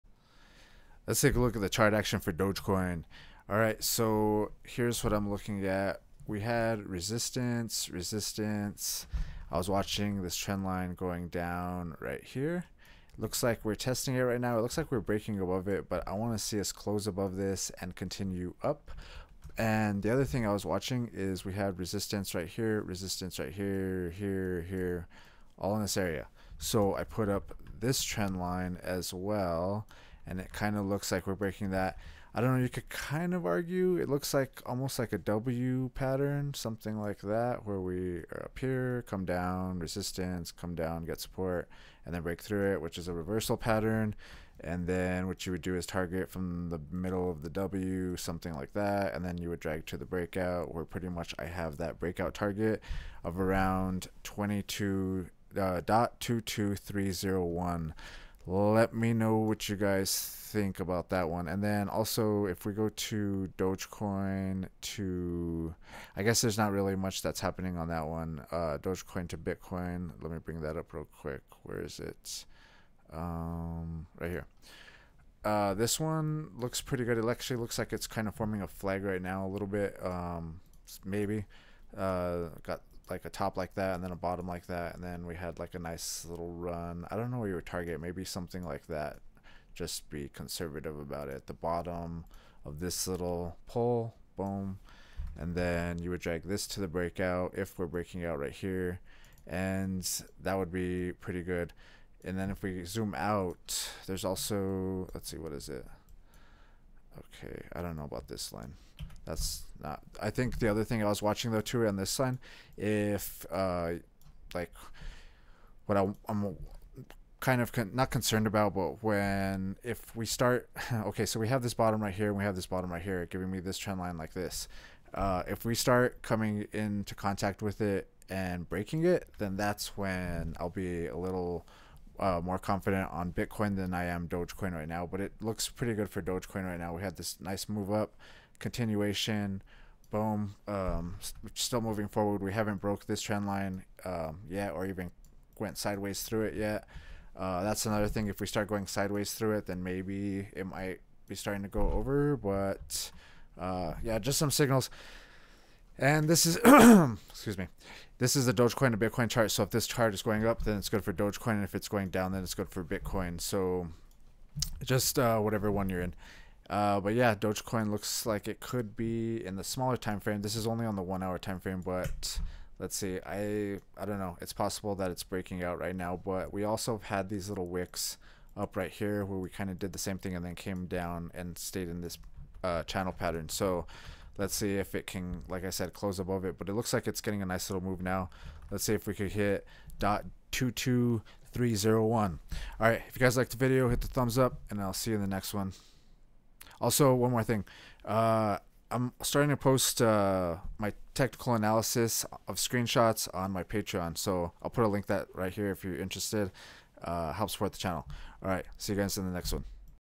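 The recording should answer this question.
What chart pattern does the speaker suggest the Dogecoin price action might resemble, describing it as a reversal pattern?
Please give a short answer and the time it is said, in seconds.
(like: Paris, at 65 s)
W pattern, at 35 s.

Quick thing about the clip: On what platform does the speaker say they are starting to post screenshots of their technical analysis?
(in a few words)
Patreon.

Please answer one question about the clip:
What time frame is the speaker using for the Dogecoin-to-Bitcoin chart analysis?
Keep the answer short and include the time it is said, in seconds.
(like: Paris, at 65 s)
one hour, at 171 s.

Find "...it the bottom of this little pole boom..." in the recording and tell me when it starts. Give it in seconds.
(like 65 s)
91 s.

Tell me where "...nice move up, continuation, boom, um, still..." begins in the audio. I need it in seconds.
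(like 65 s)
137 s.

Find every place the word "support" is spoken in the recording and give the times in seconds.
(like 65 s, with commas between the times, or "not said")
41 s, 207 s.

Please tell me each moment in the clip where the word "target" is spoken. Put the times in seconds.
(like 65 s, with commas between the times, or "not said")
45 s, 52 s, 87 s.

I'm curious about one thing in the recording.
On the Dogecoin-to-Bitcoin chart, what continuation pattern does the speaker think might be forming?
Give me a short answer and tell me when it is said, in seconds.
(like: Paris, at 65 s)
a flag, at 78 s.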